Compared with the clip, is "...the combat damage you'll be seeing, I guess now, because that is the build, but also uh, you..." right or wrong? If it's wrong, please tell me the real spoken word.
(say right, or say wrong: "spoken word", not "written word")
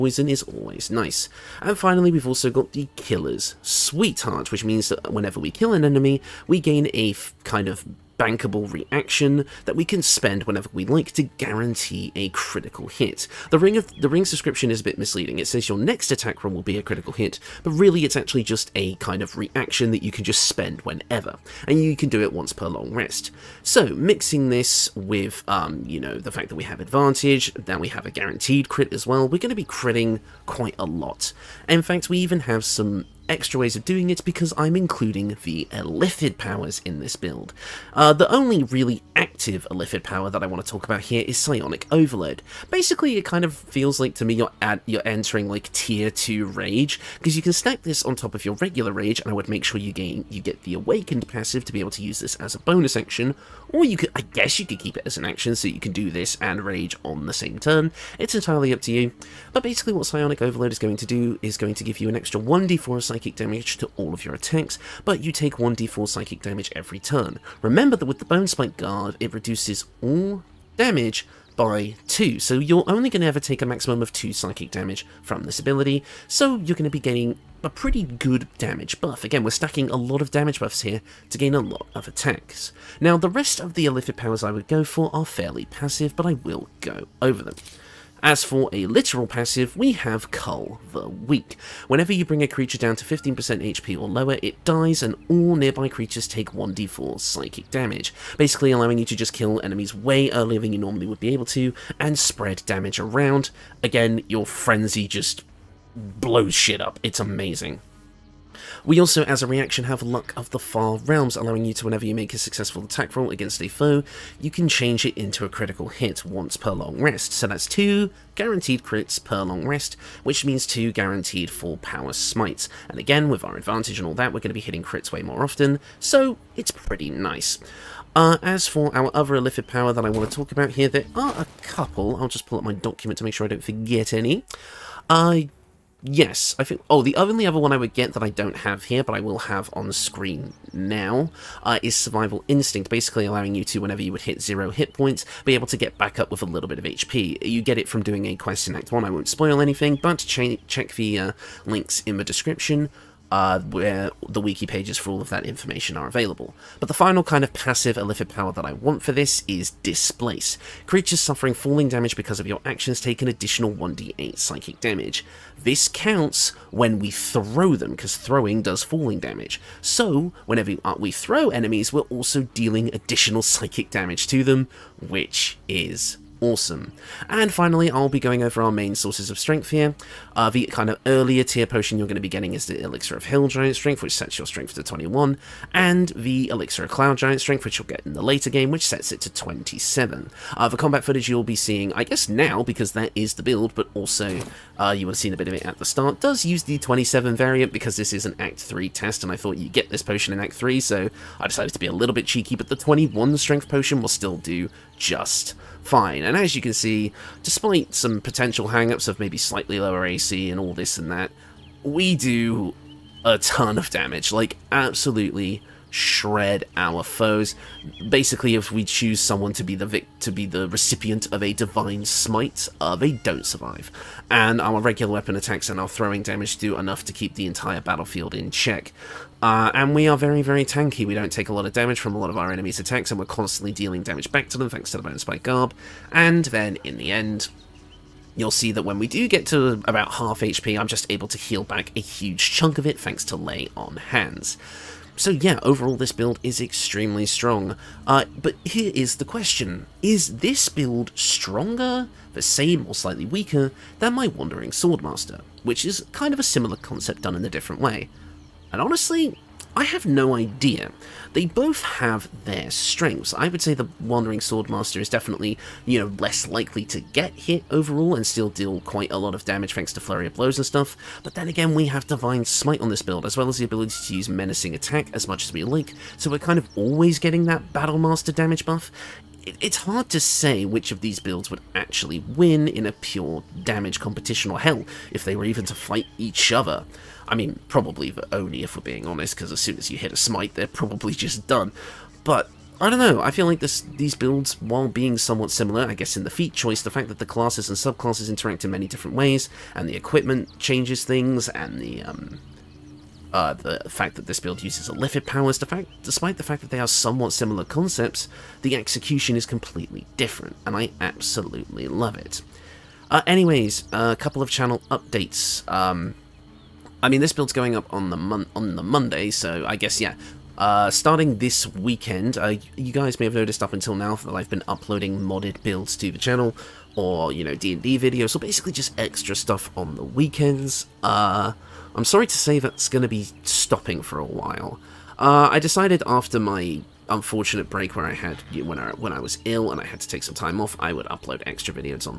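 wrong: "footage", not "damage".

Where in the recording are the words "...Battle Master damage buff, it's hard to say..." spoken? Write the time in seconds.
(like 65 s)
277 s.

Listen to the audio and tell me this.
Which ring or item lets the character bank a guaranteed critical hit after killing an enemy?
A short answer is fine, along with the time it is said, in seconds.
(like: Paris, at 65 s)
Killer's Sweetheart, at 2 s.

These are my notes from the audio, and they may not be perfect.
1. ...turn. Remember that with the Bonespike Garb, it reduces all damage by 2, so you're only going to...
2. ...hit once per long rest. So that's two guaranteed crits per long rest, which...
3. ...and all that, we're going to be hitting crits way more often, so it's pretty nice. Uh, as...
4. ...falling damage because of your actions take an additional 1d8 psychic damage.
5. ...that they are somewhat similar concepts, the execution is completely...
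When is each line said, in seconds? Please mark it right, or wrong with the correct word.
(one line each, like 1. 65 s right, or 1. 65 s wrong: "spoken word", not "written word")
1. 66 s right
2. 115 s right
3. 123 s right
4. 161 s right
5. 306 s right.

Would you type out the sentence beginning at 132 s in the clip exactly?
I'll just pull up my document to make sure I don't forget any.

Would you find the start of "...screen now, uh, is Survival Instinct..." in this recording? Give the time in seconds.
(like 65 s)
139 s.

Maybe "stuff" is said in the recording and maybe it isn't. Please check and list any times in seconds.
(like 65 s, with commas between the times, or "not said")
270 s, 329 s.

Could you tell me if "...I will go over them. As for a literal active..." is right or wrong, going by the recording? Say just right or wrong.
wrong.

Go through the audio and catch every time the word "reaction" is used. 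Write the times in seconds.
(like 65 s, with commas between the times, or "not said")
8 s, 19 s, 109 s.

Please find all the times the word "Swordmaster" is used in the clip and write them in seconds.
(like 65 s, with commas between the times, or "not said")
254 s, 264 s.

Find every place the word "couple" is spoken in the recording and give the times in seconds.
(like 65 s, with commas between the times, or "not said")
131 s, 314 s.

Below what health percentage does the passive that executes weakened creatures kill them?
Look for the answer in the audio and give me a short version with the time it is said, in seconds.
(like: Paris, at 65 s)
15%, at 93 s.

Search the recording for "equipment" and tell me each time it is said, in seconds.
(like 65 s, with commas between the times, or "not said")
299 s.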